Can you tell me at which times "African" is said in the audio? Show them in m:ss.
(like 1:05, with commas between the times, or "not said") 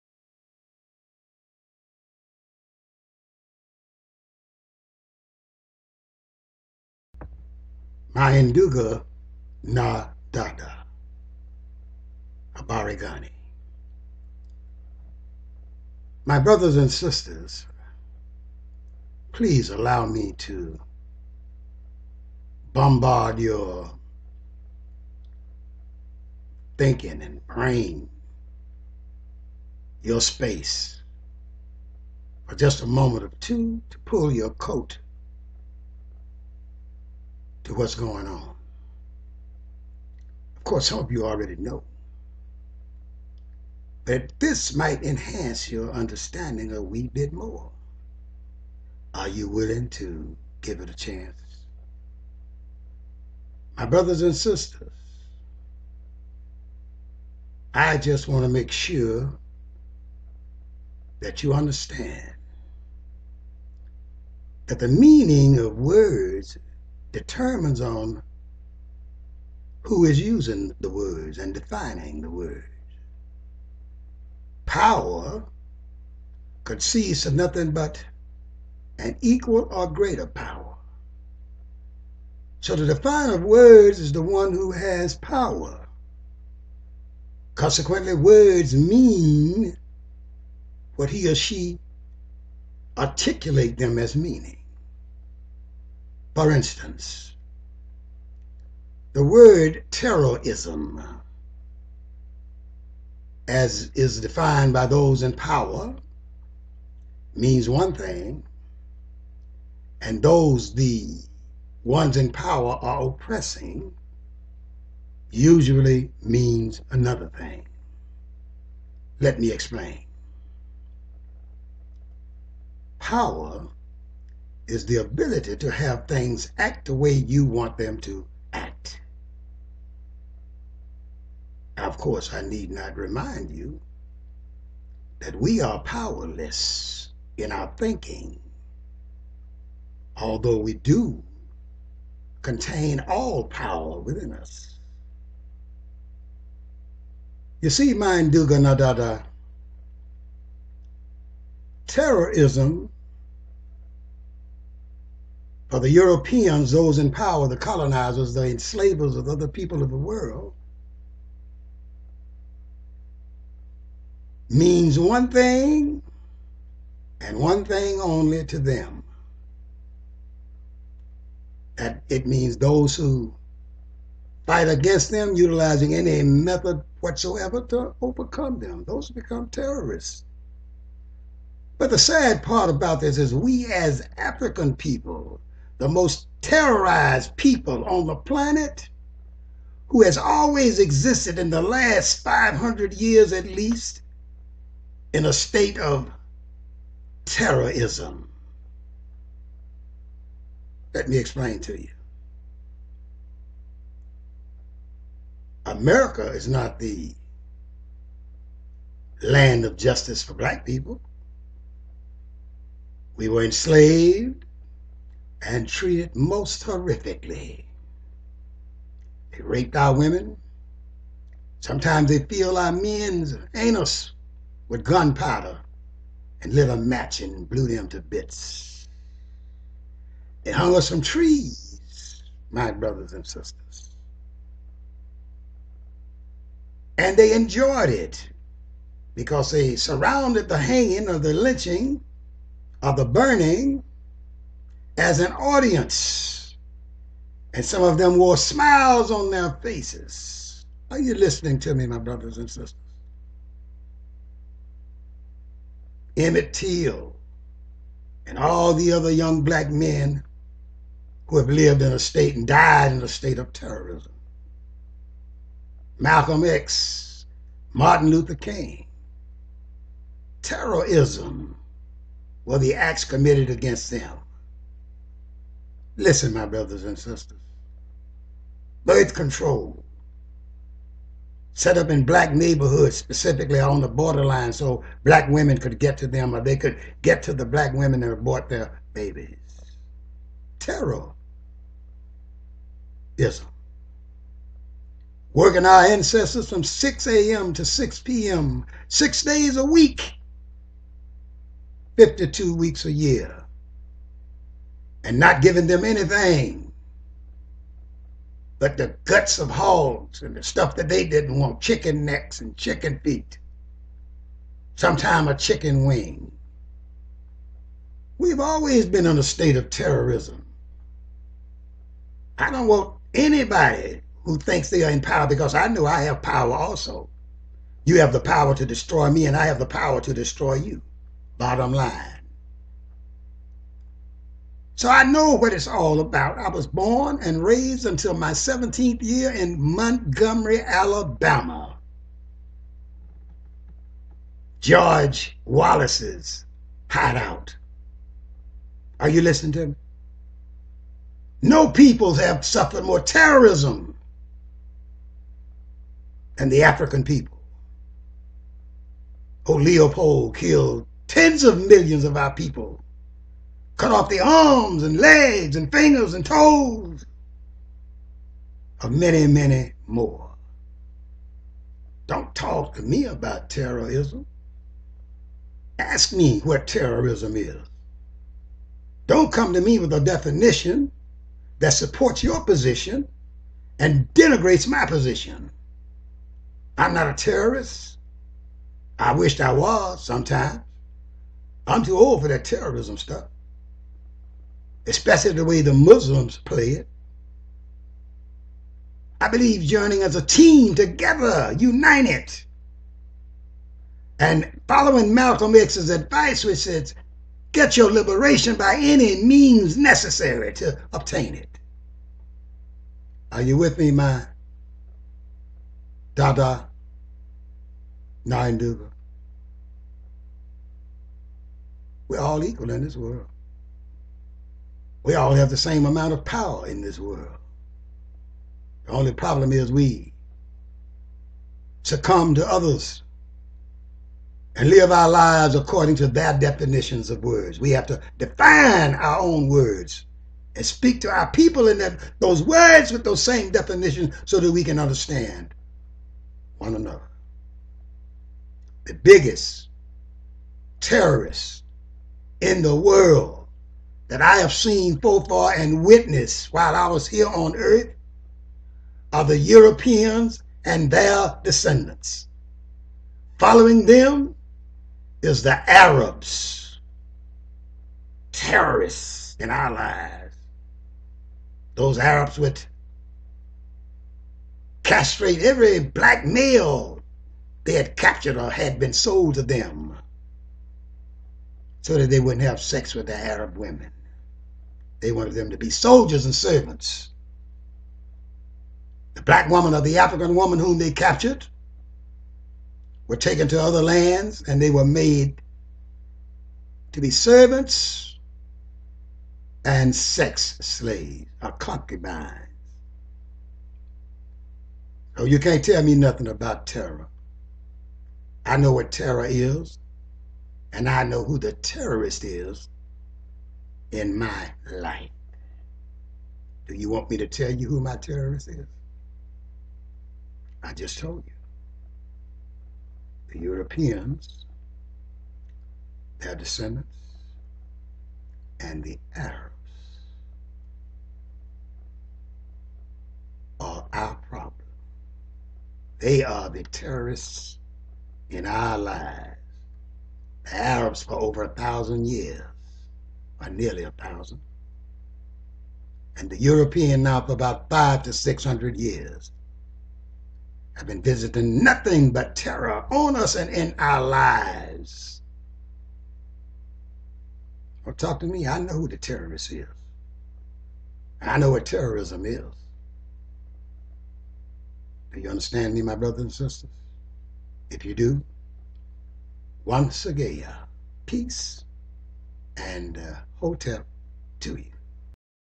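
3:04, 5:56, 8:09.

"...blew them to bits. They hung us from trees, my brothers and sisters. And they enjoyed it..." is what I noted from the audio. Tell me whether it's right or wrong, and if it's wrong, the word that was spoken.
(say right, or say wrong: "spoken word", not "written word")
right.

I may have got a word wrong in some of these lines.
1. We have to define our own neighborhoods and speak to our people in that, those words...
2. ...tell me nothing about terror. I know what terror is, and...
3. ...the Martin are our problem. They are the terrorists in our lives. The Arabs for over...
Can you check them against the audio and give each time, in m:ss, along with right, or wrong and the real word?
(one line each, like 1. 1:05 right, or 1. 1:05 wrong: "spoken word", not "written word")
1. 7:17 wrong: "words", not "neighborhoods"
2. 8:25 right
3. 8:48 wrong: "Arabs", not "Martin".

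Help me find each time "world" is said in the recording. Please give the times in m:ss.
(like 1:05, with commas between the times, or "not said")
2:39, 7:02, 7:06, 7:32.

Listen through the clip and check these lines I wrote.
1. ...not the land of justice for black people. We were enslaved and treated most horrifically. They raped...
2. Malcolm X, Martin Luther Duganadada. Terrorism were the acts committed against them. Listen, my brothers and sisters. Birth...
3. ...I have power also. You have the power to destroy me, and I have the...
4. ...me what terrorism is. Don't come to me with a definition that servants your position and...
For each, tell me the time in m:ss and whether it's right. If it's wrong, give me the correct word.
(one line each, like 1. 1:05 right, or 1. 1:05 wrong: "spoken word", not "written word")
1. 3:26 right
2. 4:25 wrong: "King", not "Duganadada"
3. 5:25 right
4. 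6:16 wrong: "supports", not "servants".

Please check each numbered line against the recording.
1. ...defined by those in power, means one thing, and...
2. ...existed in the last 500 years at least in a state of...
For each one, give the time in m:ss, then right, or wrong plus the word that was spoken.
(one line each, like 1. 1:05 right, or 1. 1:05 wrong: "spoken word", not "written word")
1. 1:44 right
2. 3:10 right.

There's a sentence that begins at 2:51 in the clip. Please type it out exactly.
That it means those who fight against them, utilizing any method whatsoever to overcome them.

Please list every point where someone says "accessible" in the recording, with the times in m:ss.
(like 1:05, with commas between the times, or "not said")
not said.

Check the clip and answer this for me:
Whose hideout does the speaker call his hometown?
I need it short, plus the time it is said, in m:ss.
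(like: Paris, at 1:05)
George Wallace, at 5:44.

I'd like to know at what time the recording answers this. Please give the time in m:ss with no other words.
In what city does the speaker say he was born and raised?
5:39.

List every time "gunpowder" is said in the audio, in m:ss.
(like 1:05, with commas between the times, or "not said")
3:44.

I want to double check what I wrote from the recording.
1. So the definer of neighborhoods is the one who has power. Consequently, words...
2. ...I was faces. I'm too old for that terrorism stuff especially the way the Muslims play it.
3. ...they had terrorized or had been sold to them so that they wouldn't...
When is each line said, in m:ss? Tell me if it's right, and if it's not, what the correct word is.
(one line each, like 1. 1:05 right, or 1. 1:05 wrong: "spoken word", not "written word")
1. 1:22 wrong: "words", not "neighborhoods"
2. 6:29 wrong: "sometimes", not "faces"
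3. 7:57 wrong: "captured", not "terrorized".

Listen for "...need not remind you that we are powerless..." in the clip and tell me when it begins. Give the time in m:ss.
2:12.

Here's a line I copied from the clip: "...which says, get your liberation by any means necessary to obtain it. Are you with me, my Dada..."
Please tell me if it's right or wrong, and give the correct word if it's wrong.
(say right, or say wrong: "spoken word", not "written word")
right.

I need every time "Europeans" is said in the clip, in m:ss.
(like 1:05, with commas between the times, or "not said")
2:35, 7:39, 8:43, 9:06.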